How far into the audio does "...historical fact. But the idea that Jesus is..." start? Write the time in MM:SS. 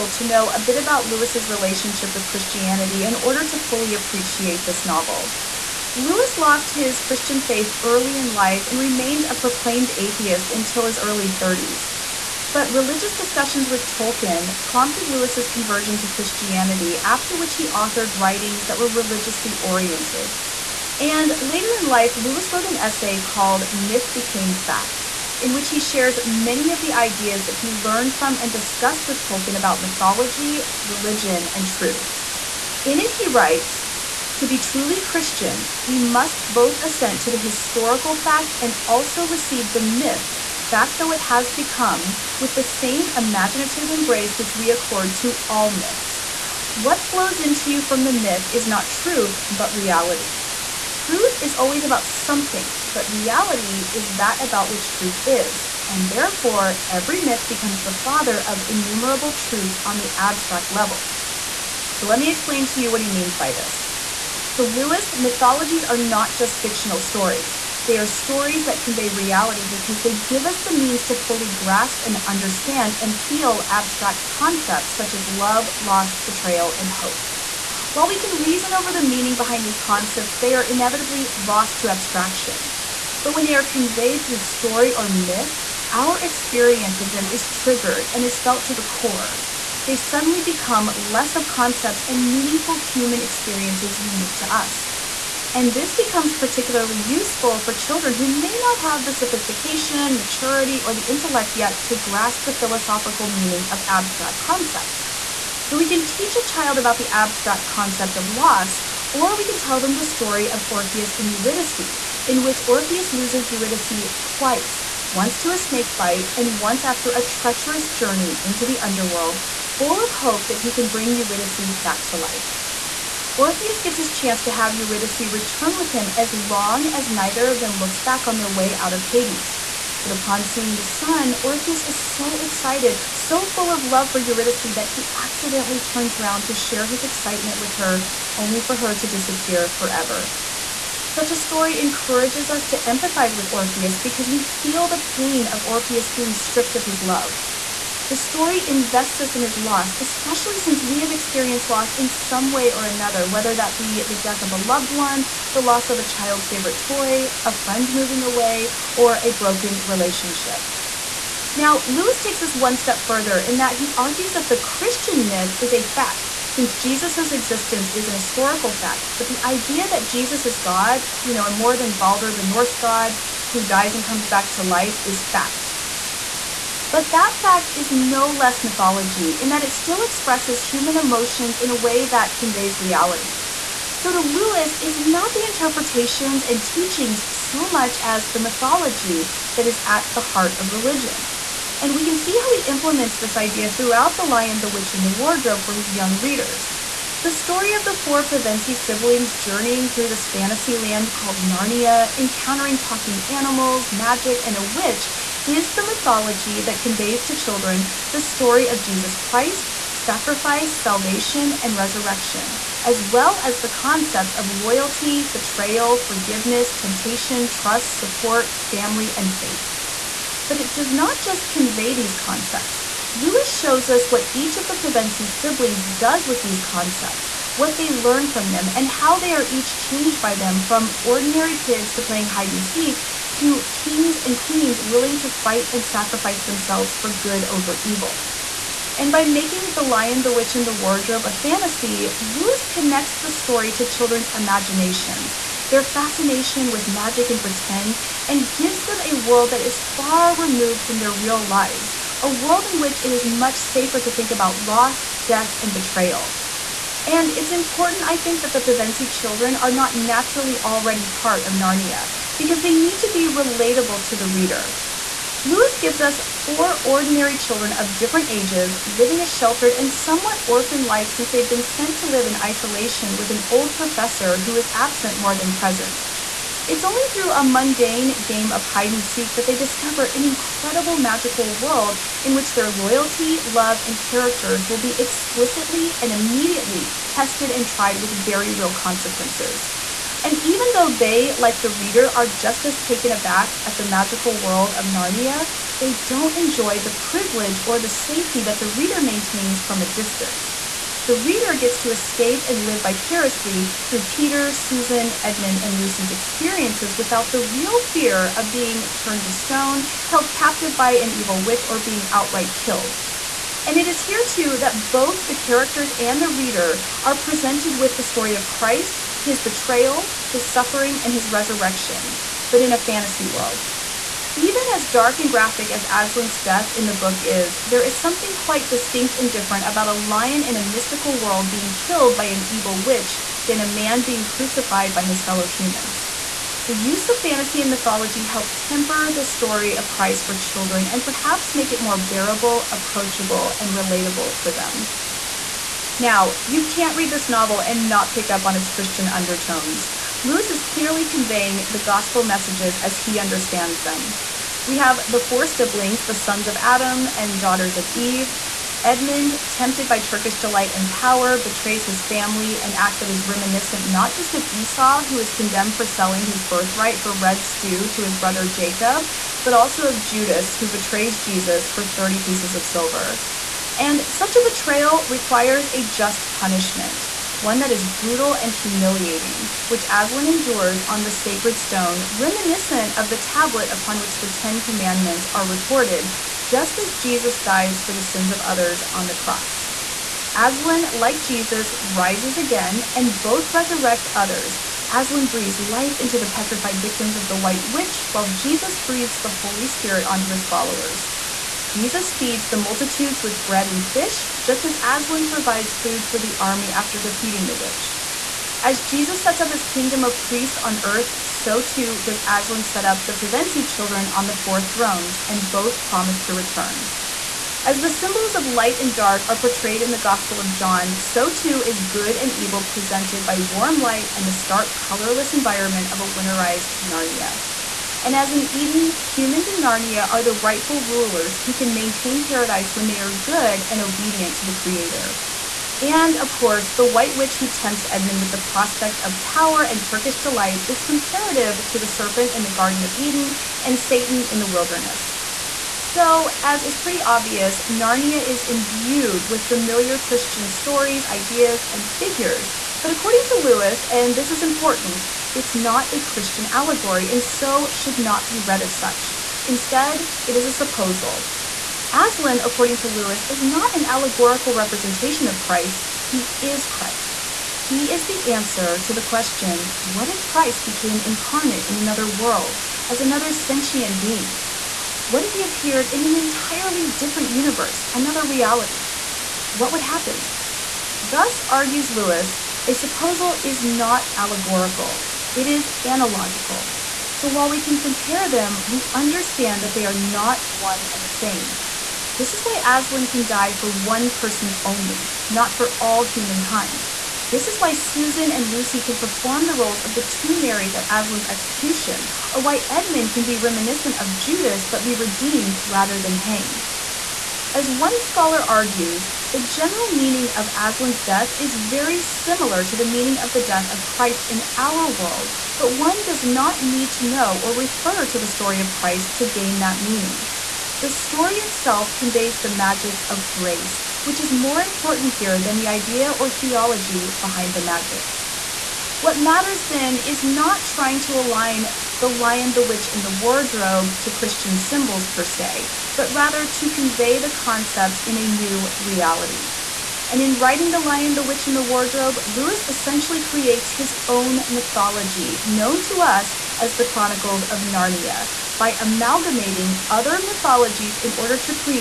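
02:48.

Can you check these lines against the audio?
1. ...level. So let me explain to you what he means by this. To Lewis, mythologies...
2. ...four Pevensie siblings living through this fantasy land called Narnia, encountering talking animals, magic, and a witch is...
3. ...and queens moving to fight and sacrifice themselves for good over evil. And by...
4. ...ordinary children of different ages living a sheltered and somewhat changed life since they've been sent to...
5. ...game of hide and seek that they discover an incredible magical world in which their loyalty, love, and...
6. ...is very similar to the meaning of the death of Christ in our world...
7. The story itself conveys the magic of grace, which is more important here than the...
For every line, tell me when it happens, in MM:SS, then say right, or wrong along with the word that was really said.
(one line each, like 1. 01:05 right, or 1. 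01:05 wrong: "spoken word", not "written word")
1. 01:00 right
2. 03:17 wrong: "journeying", not "living"
3. 03:54 wrong: "willing", not "moving"
4. 04:26 wrong: "orphaned", not "changed"
5. 04:38 right
6. 08:31 right
7. 08:40 right.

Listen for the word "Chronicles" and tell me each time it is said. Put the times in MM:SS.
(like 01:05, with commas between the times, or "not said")
09:06.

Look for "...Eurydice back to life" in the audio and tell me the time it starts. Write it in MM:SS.
02:01.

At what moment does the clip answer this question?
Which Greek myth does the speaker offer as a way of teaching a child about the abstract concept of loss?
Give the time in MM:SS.
01:50.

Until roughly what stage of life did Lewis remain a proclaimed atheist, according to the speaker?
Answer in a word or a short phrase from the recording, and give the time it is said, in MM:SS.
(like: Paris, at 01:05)
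Early 30s, at 00:10.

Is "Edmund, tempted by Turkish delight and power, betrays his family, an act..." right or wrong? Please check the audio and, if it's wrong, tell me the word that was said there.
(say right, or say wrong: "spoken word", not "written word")
right.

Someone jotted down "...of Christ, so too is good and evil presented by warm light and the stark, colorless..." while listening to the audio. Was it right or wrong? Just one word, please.
wrong.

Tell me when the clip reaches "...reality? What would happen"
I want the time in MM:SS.
07:58.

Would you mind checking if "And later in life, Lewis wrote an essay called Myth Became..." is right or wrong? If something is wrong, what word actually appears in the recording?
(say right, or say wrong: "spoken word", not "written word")
right.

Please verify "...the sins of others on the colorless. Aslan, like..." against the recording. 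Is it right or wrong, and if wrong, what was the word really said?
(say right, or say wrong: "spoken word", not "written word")
wrong: "cross", not "colorless".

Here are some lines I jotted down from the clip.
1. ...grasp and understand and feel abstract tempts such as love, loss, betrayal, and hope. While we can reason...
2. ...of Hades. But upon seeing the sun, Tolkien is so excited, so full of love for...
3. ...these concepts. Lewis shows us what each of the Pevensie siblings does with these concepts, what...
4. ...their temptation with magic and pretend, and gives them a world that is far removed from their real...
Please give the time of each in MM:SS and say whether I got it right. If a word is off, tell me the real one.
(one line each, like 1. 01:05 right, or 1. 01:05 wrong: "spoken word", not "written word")
1. 01:11 wrong: "concepts", not "tempts"
2. 02:08 wrong: "Orpheus", not "Tolkien"
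3. 03:41 right
4. 04:05 wrong: "fascination", not "temptation".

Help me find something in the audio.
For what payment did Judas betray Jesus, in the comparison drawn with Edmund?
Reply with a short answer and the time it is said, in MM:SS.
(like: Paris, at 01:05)
30 pieces of silver, at 06:11.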